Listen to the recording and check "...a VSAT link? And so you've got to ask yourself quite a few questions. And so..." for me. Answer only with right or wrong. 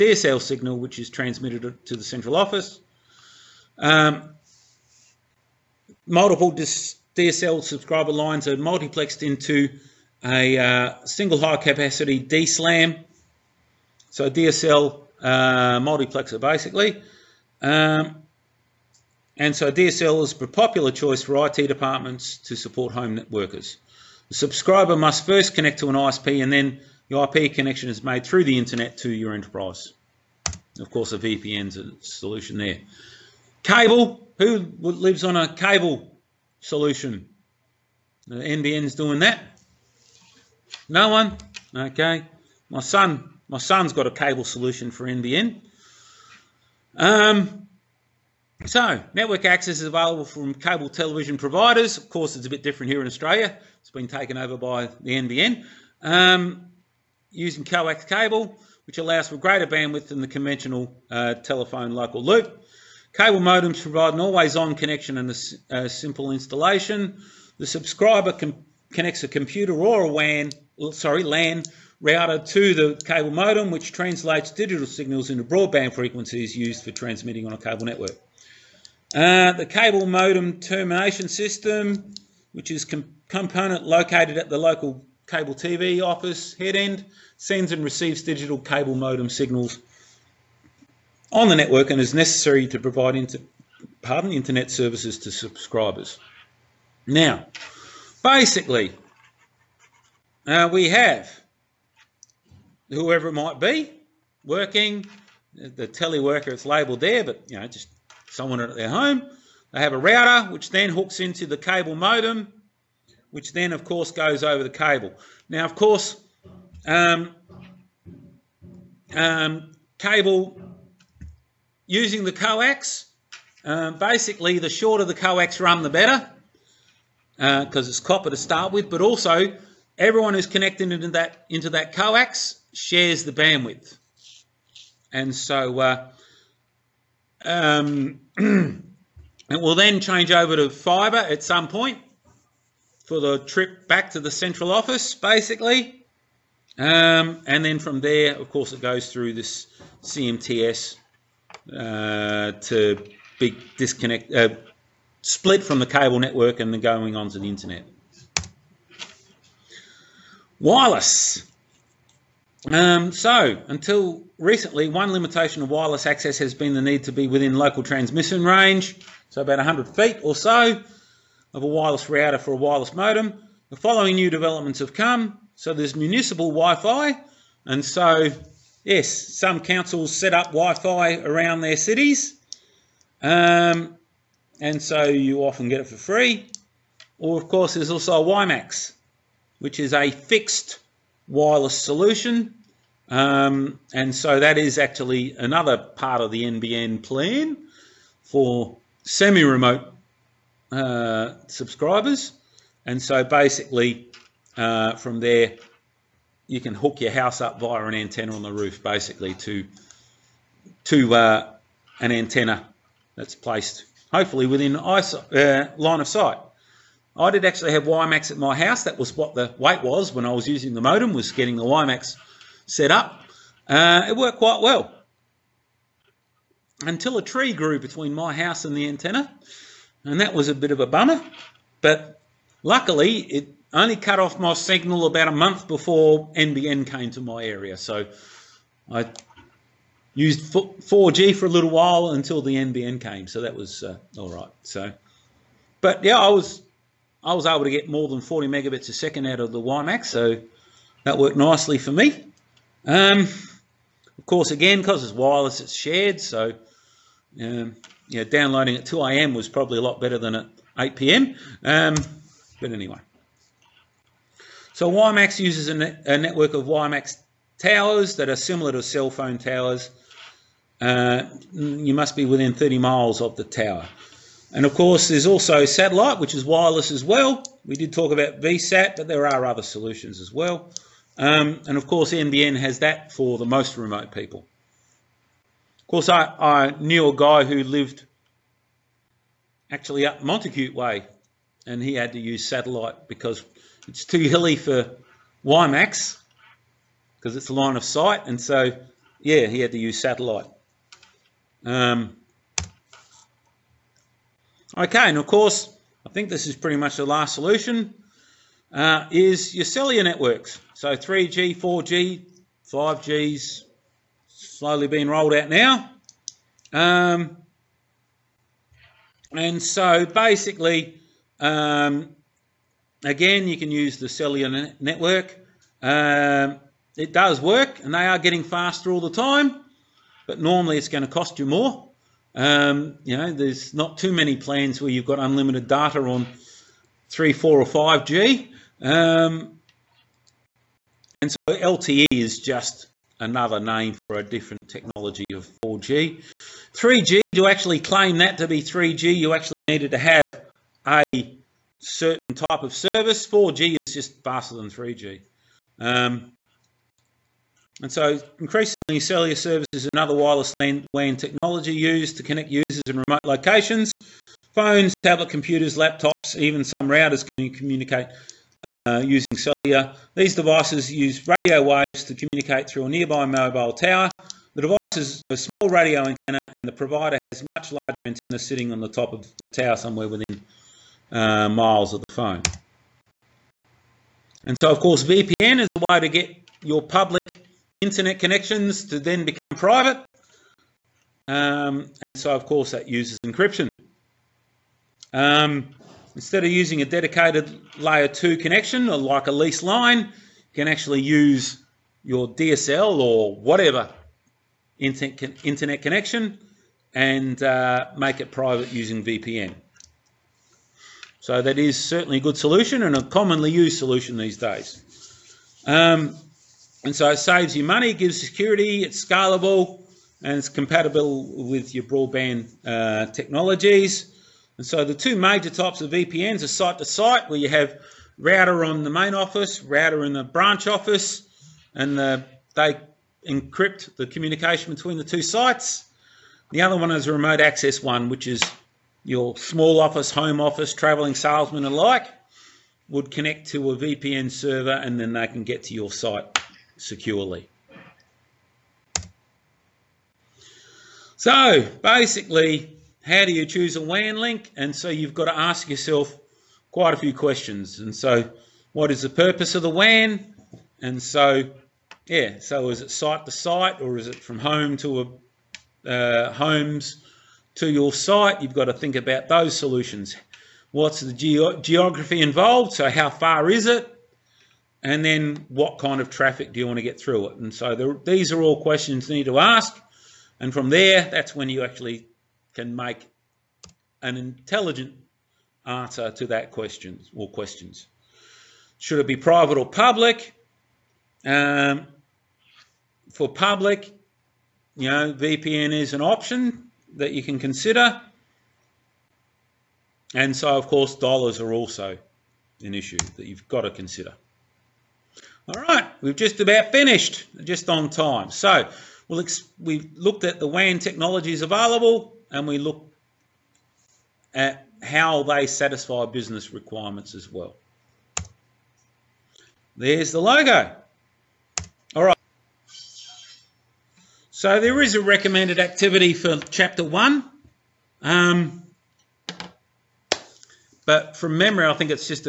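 wrong.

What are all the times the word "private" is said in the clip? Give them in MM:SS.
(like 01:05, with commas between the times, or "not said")
06:29, 06:48, 08:09.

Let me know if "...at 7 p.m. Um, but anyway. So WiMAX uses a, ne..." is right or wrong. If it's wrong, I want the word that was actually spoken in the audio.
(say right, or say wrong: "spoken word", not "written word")
wrong: "8", not "7".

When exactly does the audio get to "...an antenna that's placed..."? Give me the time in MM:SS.
03:31.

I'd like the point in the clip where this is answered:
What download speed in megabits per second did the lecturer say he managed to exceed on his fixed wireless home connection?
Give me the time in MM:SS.
04:08.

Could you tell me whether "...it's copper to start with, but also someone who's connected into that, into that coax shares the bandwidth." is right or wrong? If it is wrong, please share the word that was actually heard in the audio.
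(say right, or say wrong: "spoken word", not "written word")
wrong: "everyone", not "someone".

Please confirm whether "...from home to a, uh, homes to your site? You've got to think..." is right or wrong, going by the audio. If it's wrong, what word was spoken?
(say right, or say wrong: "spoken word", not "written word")
right.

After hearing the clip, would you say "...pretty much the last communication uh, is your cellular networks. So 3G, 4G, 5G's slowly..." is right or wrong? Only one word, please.
wrong.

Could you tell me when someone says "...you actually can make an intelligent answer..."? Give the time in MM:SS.
08:01.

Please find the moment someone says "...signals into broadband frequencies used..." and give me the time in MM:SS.
01:14.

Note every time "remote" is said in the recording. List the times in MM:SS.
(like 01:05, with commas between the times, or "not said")
03:19, 04:43, 06:02, 07:17.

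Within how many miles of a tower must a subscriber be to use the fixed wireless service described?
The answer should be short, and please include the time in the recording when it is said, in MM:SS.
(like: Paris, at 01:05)
30 miles, at 04:32.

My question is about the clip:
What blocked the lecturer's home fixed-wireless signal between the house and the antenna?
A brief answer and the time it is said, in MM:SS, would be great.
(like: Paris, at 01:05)
a tree, at 03:47.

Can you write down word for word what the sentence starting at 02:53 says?
The following new developments have come.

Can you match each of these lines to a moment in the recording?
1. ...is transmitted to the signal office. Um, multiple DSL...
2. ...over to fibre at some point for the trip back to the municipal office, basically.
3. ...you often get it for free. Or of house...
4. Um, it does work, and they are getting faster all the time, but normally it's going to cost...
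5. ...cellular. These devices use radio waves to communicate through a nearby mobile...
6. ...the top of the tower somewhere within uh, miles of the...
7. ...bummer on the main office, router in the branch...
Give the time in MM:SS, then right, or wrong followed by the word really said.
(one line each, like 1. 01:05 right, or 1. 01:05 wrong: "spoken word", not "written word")
1. 00:00 wrong: "central", not "signal"
2. 02:20 wrong: "central", not "municipal"
3. 03:05 wrong: "course", not "house"
4. 05:25 right
5. 06:09 right
6. 06:18 right
7. 07:08 wrong: "router", not "bummer".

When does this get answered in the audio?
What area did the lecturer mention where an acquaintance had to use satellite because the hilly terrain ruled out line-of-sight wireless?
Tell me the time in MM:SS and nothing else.
04:50.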